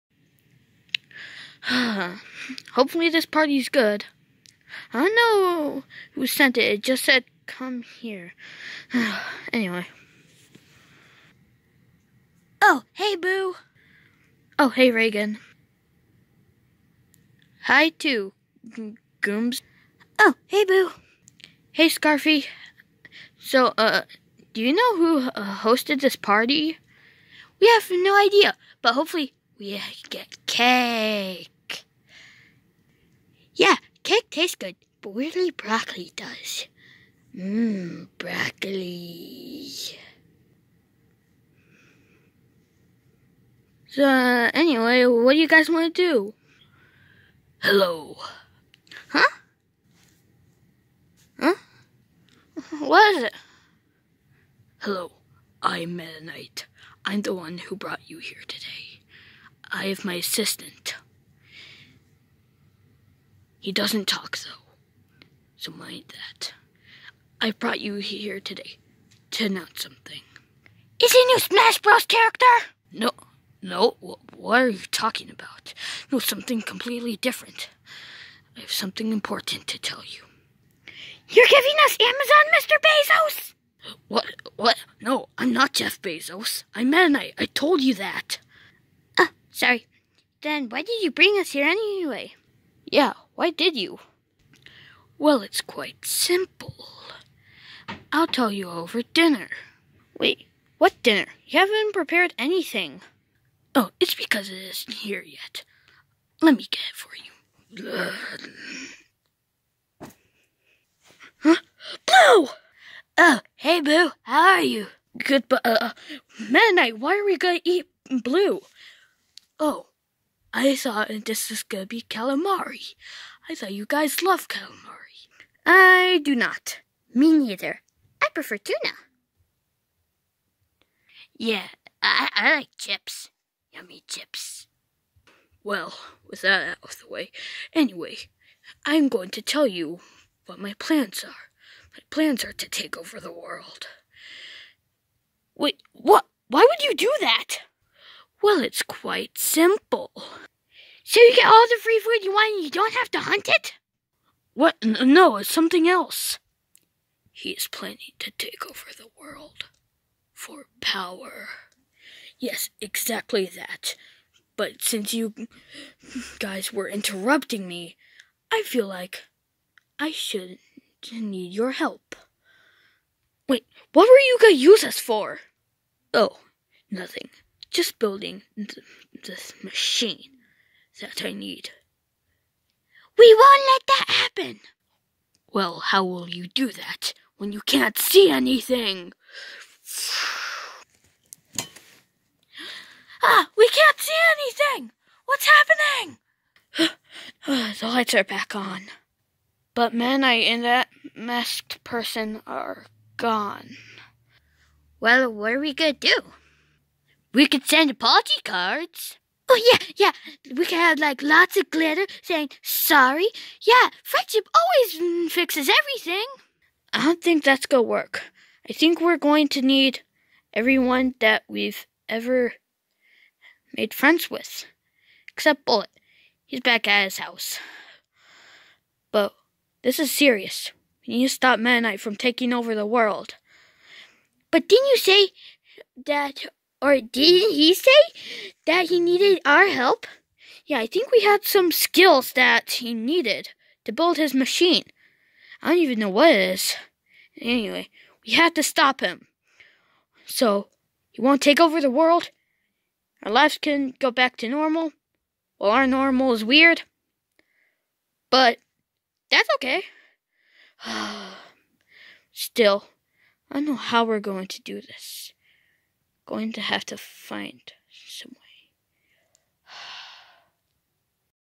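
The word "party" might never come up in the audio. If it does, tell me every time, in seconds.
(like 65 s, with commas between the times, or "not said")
3 s, 26 s, 207 s.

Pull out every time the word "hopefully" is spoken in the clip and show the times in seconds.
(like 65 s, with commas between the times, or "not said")
2 s, 28 s.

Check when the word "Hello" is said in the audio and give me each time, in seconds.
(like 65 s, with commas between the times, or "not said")
47 s, 54 s.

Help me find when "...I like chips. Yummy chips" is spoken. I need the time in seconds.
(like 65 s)
132 s.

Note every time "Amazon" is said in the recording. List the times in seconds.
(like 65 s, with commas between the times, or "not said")
81 s.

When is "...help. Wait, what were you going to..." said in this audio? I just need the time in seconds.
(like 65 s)
171 s.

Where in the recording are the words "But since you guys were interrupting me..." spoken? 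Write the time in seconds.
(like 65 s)
164 s.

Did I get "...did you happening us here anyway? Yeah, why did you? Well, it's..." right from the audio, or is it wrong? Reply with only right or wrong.
wrong.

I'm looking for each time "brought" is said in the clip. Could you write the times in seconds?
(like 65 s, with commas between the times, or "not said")
57 s, 67 s.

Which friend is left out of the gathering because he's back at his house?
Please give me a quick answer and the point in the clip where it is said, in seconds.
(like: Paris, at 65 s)
Bullet, at 225 s.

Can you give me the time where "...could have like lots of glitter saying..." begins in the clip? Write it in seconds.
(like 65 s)
210 s.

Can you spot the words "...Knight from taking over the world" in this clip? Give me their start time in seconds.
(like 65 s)
231 s.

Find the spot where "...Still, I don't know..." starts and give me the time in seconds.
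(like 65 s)
262 s.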